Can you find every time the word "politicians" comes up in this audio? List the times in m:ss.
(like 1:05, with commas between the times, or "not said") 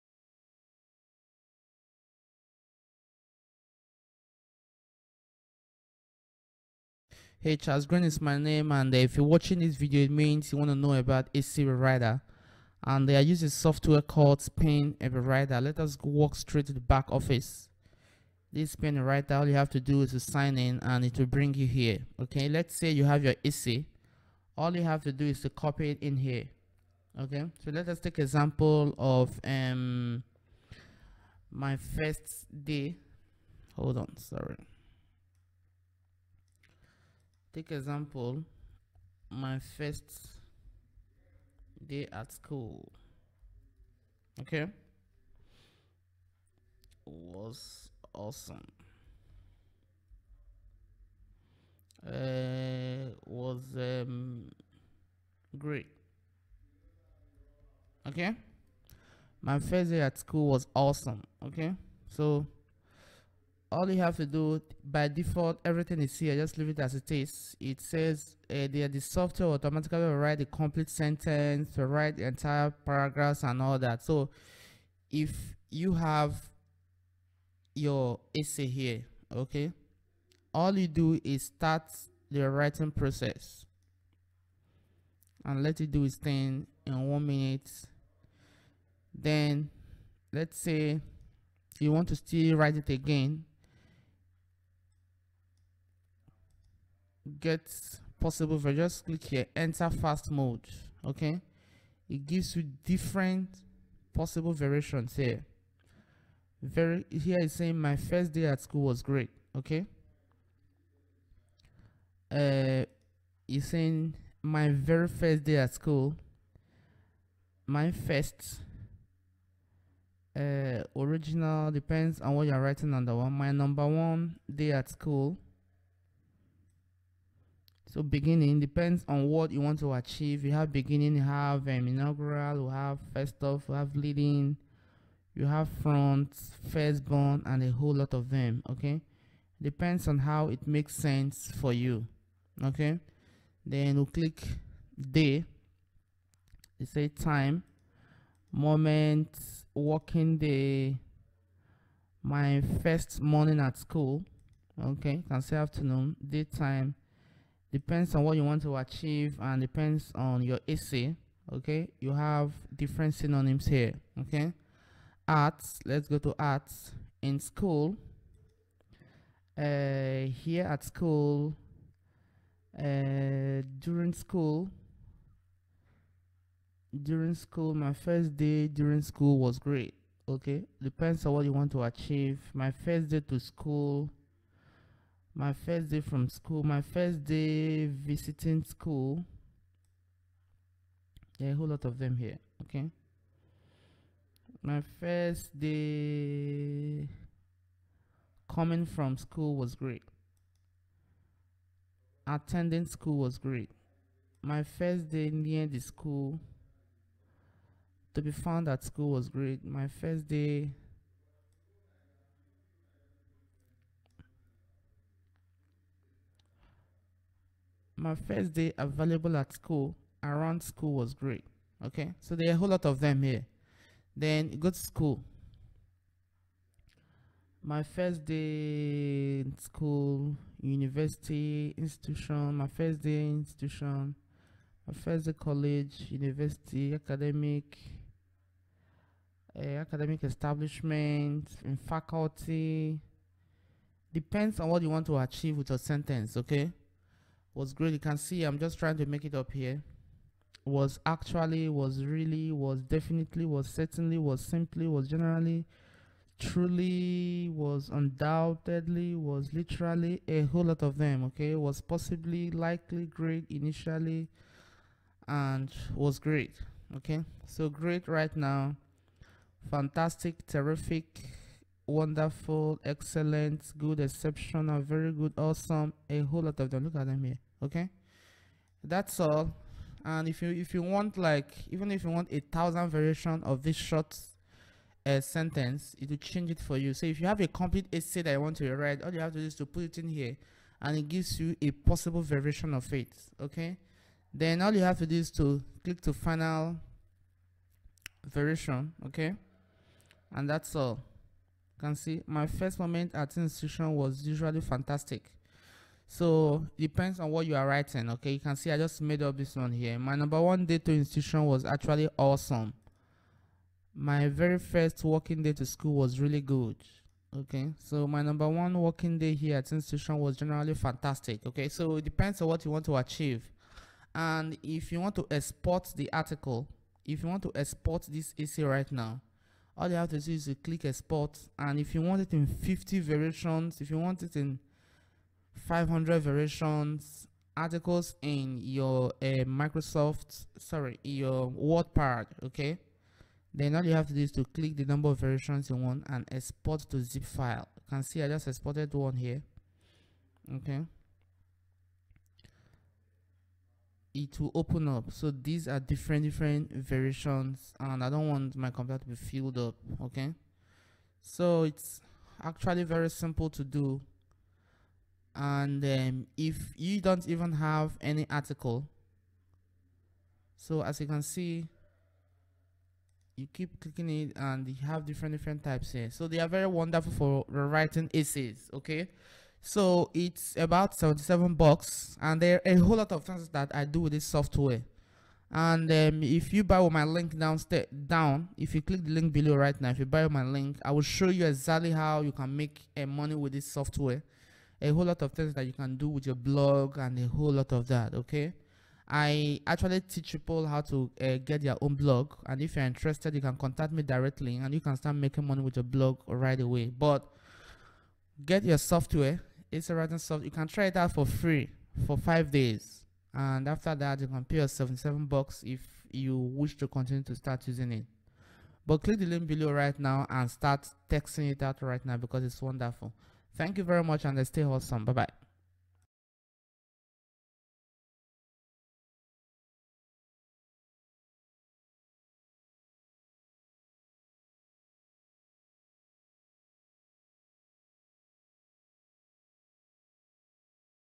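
not said.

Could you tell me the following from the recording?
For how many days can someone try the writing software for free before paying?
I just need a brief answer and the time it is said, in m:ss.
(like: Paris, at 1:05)
5, at 6:52.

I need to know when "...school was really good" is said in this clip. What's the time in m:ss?
5:15.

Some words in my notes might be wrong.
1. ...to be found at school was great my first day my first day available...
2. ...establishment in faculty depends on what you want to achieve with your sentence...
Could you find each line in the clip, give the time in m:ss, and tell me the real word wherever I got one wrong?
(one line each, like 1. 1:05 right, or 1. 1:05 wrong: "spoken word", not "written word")
1. 3:28 right
2. 4:00 right.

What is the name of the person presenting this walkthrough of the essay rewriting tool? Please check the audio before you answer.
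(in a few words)
Charles Green.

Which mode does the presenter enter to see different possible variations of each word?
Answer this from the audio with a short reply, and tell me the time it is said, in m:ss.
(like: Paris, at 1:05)
fast mode, at 1:39.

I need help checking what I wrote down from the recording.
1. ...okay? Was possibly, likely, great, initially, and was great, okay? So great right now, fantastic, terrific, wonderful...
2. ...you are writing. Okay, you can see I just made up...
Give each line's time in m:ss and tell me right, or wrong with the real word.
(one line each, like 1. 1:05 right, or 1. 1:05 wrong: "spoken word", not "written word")
1. 4:21 right
2. 5:07 right.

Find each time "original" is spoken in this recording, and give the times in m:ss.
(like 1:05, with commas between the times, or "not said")
2:00.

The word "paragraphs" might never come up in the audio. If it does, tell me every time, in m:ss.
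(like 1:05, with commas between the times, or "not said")
1:12.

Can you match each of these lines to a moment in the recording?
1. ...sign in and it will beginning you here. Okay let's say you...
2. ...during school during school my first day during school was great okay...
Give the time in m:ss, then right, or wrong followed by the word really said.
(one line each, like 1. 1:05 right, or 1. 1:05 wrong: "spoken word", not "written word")
1. 0:20 wrong: "bring", not "beginning"
2. 2:53 right.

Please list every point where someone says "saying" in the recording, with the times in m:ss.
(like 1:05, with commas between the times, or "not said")
1:47, 1:53.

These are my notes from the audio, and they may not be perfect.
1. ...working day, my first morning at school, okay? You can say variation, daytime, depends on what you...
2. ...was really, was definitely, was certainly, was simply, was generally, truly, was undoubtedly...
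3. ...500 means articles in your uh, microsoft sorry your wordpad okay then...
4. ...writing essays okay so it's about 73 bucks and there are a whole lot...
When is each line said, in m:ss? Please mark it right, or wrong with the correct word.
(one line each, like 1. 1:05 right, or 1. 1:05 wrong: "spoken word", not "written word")
1. 2:29 wrong: "afternoon", not "variation"
2. 4:11 right
3. 5:35 wrong: "variations", not "means"
4. 6:17 wrong: "77", not "73".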